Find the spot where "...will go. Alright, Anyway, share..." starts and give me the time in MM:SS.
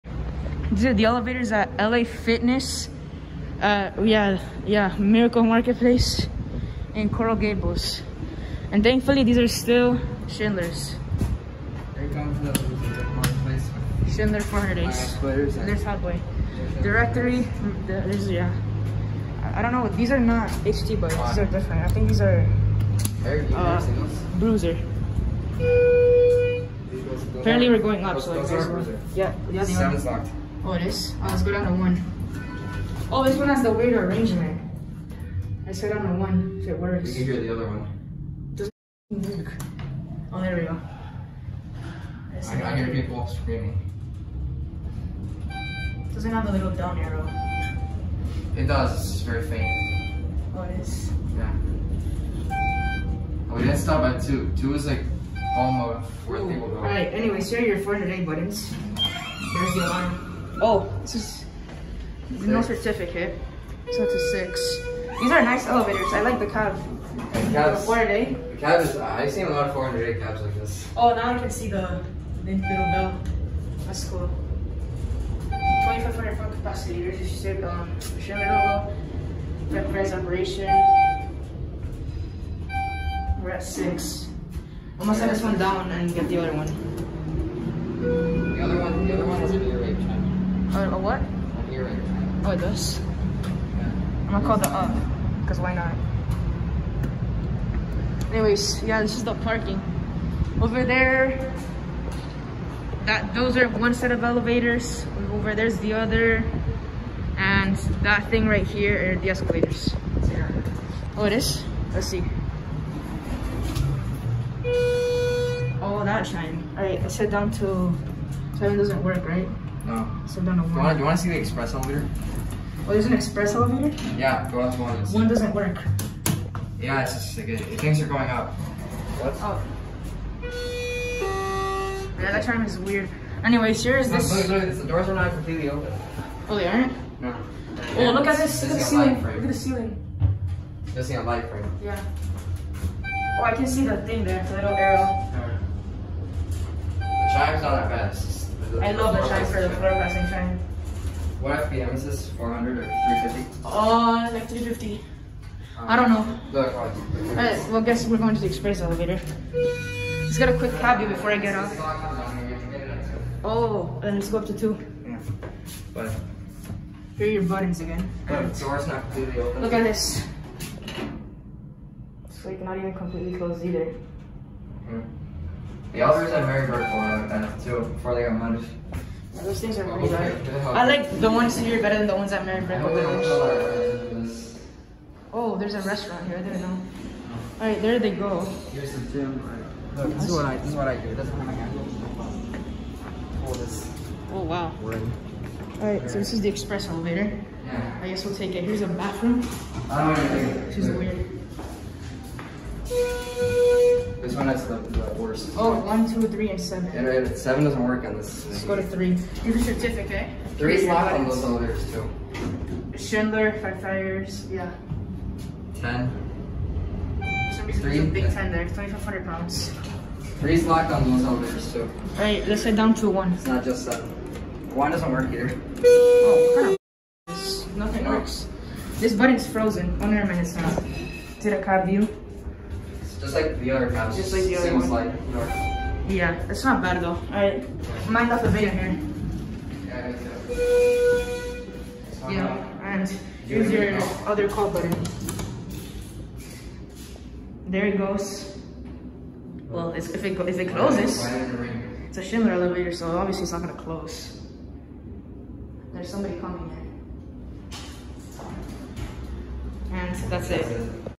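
00:56.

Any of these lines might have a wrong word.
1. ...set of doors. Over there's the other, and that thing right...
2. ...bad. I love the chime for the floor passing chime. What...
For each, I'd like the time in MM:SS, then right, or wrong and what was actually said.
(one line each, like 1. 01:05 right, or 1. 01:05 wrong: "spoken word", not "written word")
1. 01:43 wrong: "elevators", not "doors"
2. 02:27 right.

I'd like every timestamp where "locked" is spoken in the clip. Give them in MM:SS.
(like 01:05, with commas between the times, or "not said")
03:30, 03:40.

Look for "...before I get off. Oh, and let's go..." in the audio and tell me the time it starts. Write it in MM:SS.
02:41.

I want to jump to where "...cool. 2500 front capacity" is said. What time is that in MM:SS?
01:14.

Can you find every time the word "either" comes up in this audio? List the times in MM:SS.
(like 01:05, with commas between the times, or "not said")
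02:53, 03:45.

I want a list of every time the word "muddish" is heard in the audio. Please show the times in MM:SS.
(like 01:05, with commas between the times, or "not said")
02:58.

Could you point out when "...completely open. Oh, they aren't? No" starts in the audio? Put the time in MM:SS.
02:15.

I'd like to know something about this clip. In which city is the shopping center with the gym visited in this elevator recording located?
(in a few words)
Coral Gables.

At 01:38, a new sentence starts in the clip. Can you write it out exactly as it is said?
Anyways, yeah, this is the parking.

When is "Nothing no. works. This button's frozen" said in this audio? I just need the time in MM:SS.
03:47.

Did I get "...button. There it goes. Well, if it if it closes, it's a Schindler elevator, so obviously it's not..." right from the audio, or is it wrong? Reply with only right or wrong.
right.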